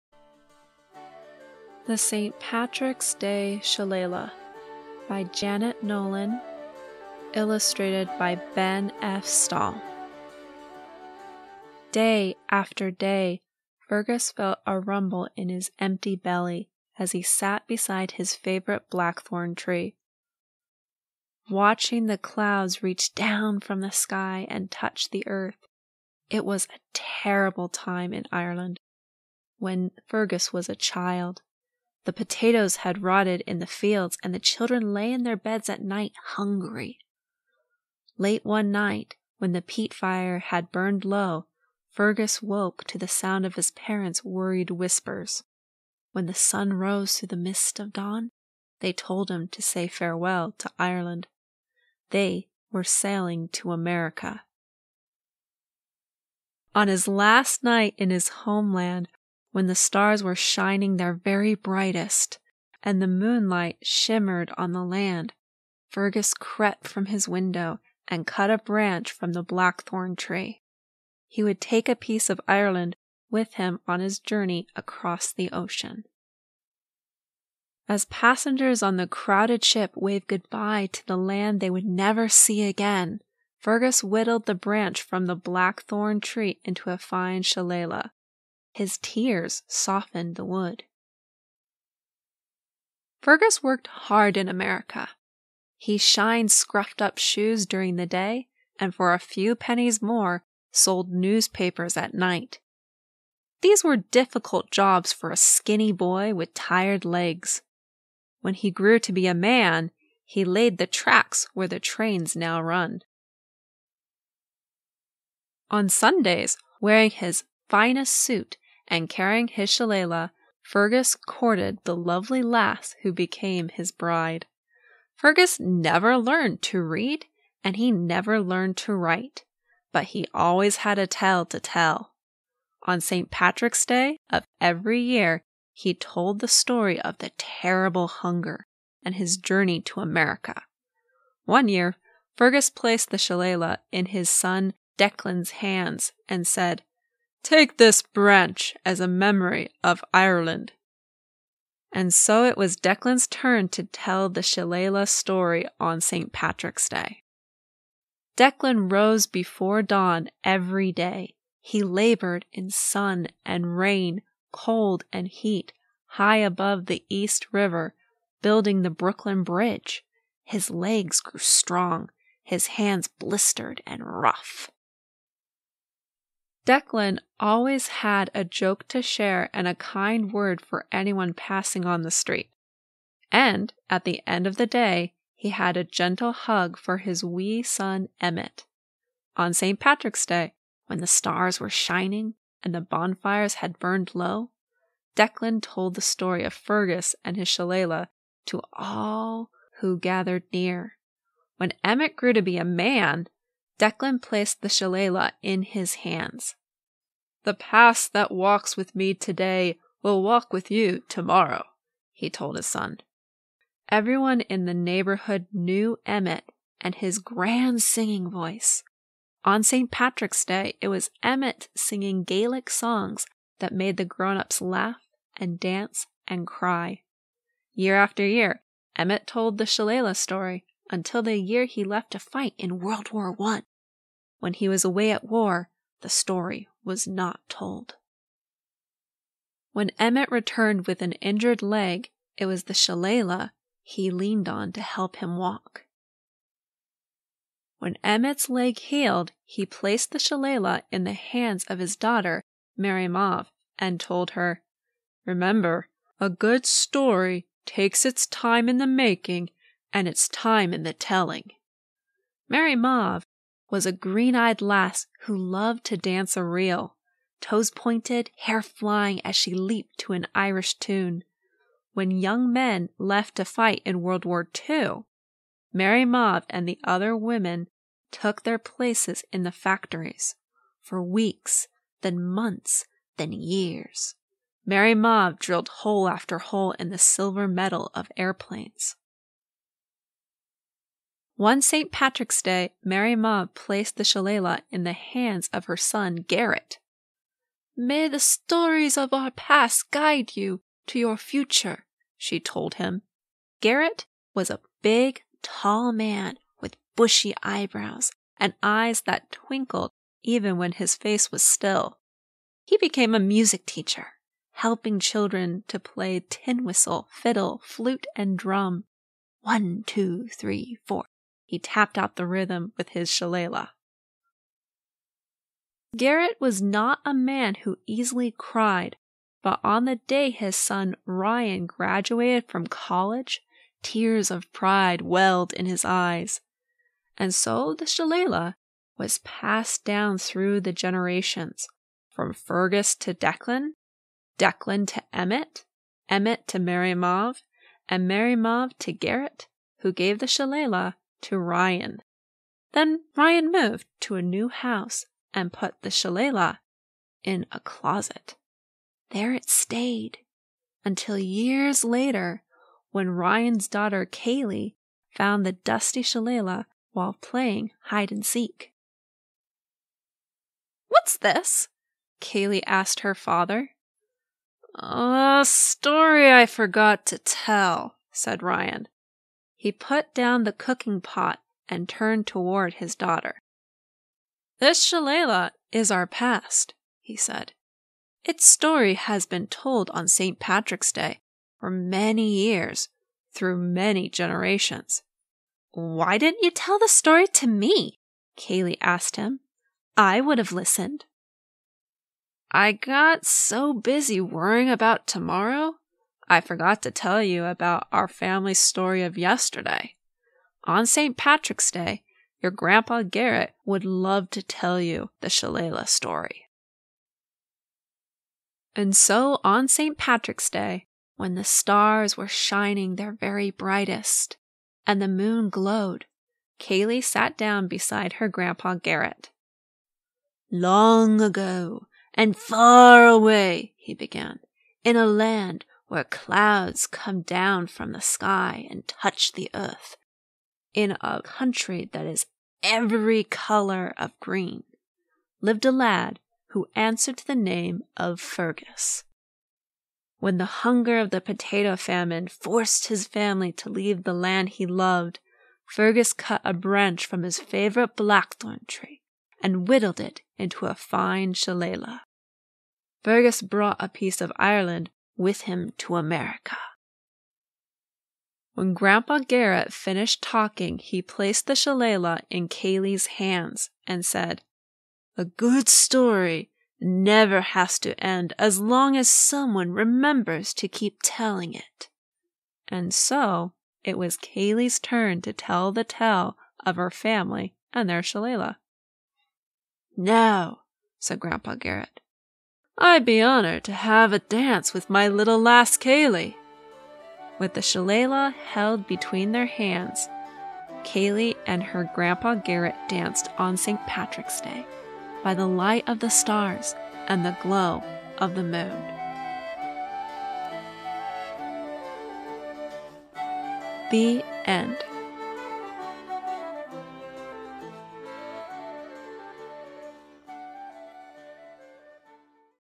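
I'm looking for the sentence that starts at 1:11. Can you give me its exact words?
He would take a piece of Ireland with him on his journey across the ocean.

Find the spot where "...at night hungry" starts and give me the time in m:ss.
0:35.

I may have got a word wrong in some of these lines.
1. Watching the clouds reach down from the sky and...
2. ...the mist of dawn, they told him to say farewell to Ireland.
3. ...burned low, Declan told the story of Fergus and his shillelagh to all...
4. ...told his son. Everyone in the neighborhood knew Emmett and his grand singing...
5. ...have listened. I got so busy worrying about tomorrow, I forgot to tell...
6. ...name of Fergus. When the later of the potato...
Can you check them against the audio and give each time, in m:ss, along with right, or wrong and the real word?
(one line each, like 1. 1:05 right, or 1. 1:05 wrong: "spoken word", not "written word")
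1. 0:21 right
2. 0:47 right
3. 3:13 right
4. 3:32 right
5. 6:40 right
6. 7:27 wrong: "hunger", not "later".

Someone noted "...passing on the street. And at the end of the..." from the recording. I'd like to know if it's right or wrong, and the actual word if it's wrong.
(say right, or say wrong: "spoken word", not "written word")
right.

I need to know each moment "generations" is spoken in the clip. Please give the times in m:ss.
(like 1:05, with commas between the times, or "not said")
5:40, 6:34.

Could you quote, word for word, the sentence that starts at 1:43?
These were difficult jobs for a skinny boy with tired legs.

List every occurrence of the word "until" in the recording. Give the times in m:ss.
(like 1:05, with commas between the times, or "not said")
3:50, 6:00.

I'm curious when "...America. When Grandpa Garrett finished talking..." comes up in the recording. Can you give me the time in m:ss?
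7:45.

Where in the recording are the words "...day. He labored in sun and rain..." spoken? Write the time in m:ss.
2:40.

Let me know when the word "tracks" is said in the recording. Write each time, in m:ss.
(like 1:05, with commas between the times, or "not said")
1:50.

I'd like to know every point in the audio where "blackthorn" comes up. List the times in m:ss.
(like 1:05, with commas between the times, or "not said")
0:18, 1:09, 1:25, 7:37.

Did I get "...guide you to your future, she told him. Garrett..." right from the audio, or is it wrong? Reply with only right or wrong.
right.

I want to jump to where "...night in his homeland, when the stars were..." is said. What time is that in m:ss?
0:57.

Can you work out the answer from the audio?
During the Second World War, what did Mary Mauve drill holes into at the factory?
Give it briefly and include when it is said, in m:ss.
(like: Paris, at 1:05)
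airplanes, at 4:48.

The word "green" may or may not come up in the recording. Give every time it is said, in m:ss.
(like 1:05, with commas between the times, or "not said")
4:23, 7:24.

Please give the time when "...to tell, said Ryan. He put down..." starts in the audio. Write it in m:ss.
6:17.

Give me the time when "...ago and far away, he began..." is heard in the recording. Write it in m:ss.
7:11.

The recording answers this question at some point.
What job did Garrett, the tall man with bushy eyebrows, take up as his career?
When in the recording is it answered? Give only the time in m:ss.
5:13.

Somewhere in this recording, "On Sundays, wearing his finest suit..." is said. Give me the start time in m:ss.
1:55.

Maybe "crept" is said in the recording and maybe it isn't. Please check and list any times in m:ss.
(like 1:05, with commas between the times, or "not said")
1:06.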